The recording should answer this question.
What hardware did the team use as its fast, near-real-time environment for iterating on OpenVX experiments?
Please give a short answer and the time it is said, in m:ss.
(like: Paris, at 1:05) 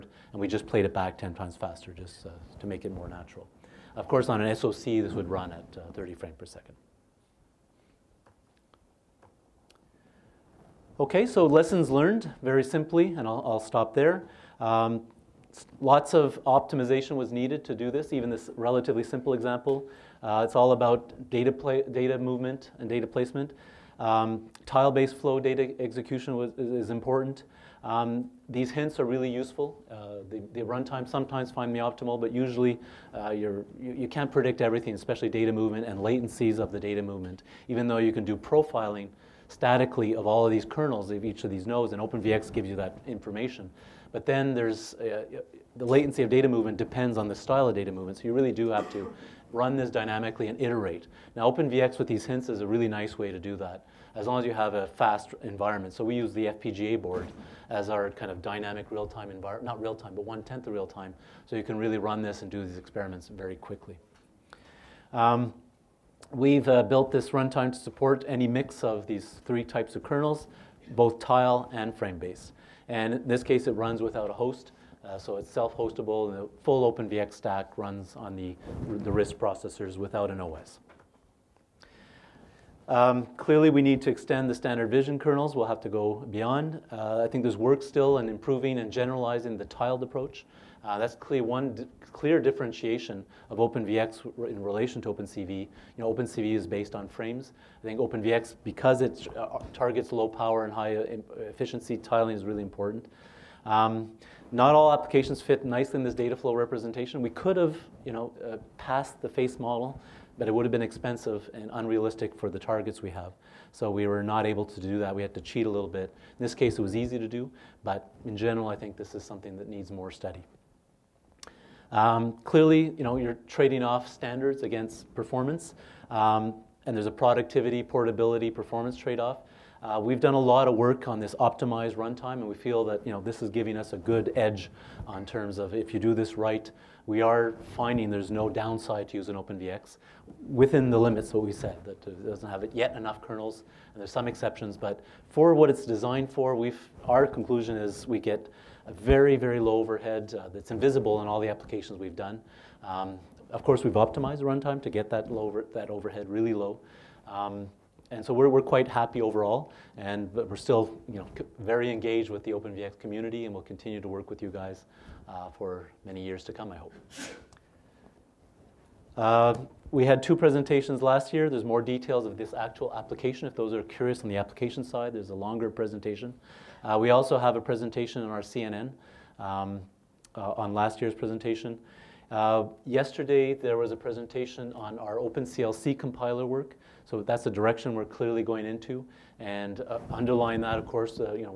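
FPGA board, at 0:56.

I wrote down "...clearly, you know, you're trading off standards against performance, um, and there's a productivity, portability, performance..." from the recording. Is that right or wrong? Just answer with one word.
right.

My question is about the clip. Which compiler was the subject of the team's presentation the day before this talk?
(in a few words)
OpenCLC compiler.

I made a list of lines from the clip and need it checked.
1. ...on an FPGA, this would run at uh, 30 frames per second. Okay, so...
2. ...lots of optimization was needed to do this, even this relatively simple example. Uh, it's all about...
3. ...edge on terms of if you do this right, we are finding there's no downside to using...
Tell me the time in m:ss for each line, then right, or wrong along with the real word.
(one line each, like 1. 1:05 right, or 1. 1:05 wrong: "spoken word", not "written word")
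1. 0:04 wrong: "SoC", not "FPGA"
2. 0:15 right
3. 2:14 right.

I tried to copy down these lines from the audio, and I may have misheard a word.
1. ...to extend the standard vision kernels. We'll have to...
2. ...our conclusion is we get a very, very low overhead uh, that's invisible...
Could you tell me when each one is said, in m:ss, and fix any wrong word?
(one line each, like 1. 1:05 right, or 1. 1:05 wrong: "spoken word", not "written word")
1. 1:24 right
2. 2:27 right.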